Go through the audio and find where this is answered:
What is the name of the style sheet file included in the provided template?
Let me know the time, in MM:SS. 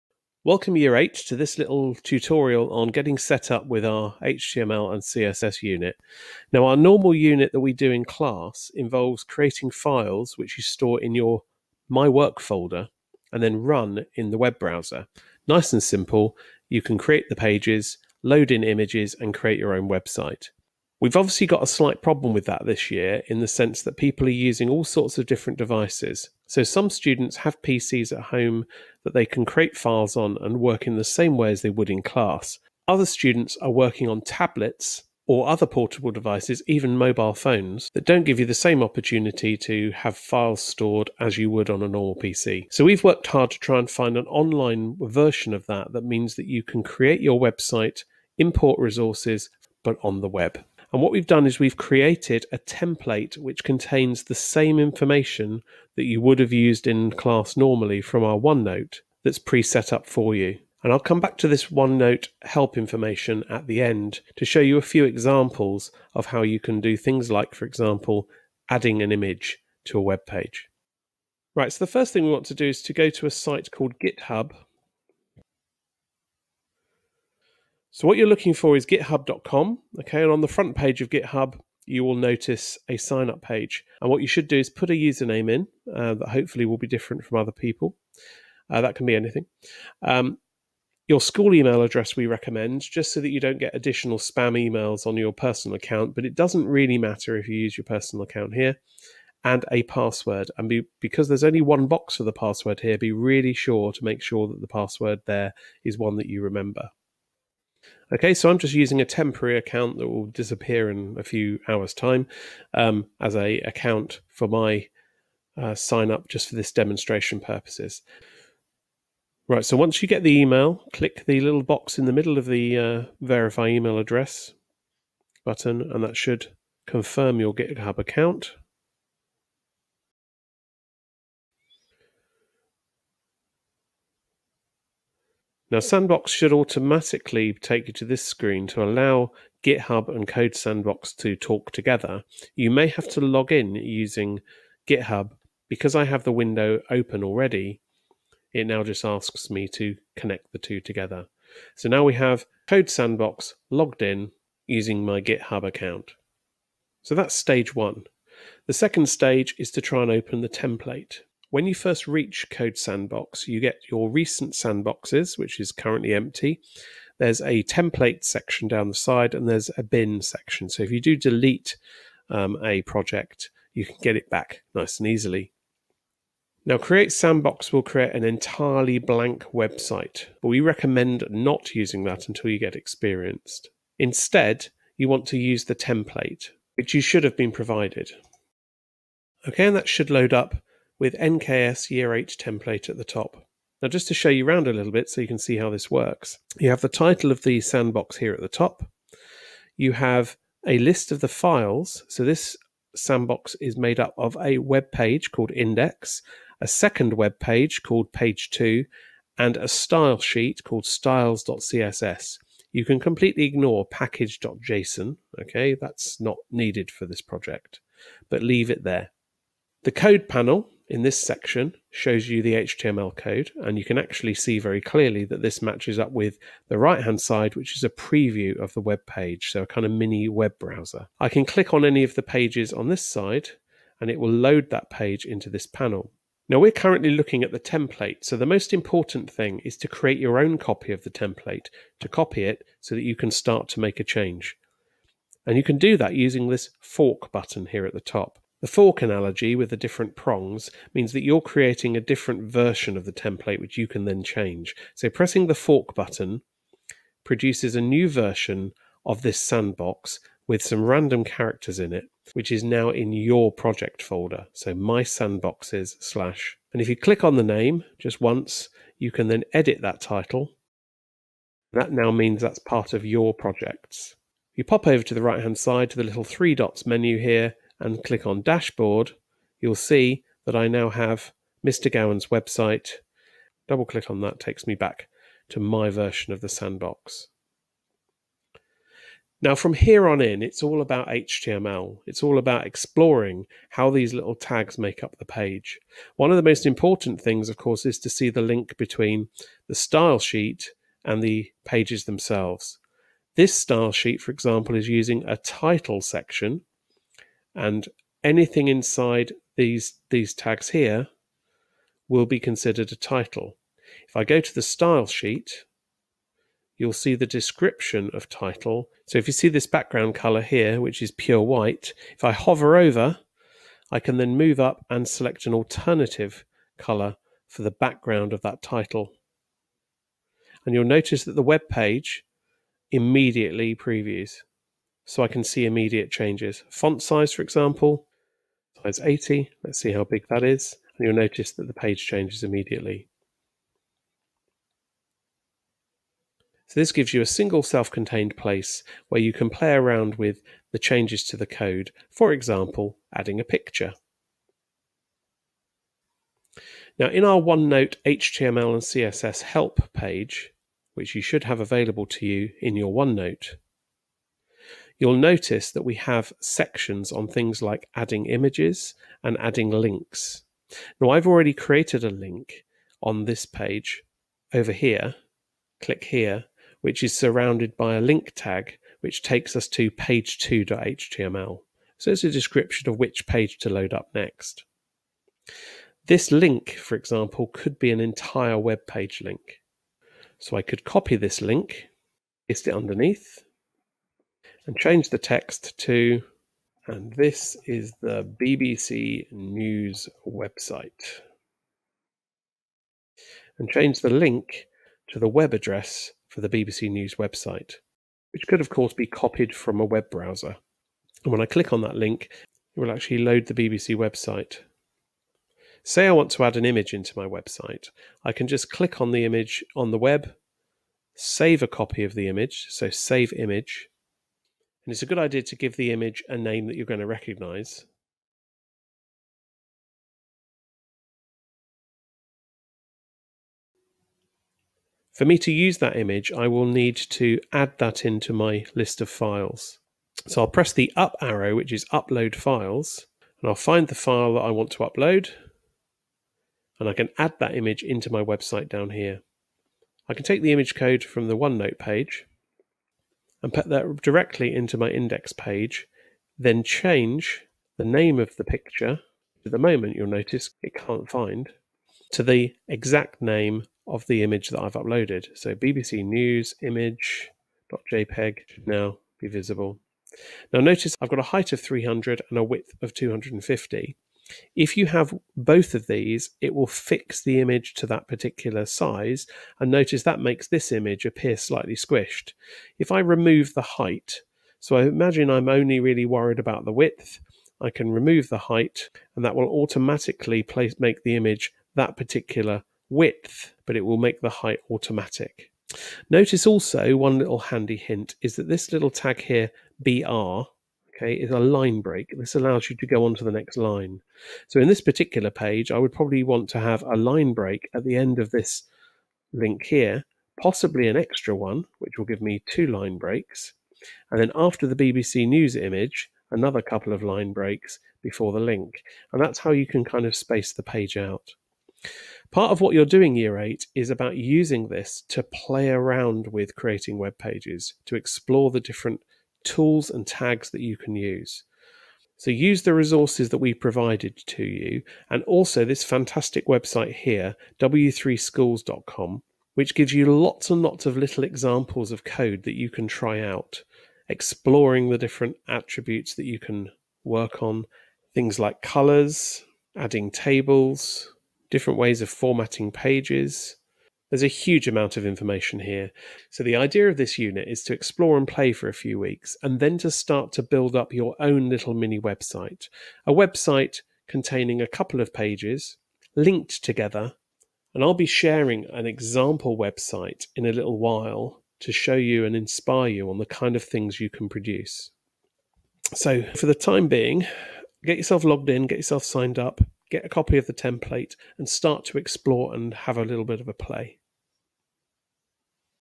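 03:30.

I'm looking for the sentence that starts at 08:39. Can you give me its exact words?
And that's how you can kind of space the page out.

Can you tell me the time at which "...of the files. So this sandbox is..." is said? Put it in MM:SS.
03:21.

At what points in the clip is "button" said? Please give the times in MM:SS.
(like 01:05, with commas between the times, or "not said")
02:05, 04:07, 04:15.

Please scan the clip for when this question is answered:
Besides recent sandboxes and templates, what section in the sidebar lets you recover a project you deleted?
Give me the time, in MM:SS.
02:49.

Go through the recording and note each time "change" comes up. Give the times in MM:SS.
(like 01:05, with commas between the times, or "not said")
04:04, 04:14, 05:36, 05:42, 05:50, 06:34, 06:43, 07:36.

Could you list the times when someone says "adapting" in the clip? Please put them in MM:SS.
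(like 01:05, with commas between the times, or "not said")
not said.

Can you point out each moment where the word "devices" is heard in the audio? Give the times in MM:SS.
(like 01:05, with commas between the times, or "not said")
00:25, 00:36.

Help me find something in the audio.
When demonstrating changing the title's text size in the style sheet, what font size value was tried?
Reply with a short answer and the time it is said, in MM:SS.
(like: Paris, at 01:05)
80, at 05:38.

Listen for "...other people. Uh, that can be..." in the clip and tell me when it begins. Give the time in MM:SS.
01:27.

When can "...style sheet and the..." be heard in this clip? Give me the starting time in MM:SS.
04:59.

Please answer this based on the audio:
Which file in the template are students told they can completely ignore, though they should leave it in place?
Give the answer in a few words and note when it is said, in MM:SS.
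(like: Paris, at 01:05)
package.json, at 03:33.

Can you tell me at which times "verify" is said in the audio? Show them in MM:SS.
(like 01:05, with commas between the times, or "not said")
02:03.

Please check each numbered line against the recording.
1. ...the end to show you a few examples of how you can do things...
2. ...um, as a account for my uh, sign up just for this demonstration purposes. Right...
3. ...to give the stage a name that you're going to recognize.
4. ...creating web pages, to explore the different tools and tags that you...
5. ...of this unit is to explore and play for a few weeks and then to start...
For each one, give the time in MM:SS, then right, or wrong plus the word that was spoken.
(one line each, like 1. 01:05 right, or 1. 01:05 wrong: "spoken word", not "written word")
1. 01:03 right
2. 01:52 right
3. 07:05 wrong: "image", not "stage"
4. 08:46 right
5. 09:16 right.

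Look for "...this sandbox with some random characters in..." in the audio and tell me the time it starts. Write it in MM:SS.
04:19.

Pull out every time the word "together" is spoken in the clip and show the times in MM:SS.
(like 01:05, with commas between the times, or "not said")
02:21, 02:30, 09:26.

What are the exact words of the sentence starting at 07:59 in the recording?
And notice that makes this image appear slightly squished.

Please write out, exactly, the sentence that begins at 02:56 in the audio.
Now, Create Sandbox will create an entirely blank website, but we recommend not using that until you get experienced.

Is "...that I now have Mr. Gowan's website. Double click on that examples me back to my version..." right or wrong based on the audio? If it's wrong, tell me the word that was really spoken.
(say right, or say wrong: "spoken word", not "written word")
wrong: "takes", not "examples".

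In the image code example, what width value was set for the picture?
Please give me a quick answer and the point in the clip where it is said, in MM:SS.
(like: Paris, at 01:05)
250, at 07:52.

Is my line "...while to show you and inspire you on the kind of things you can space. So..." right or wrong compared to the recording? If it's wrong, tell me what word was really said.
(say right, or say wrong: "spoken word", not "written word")
wrong: "produce", not "space".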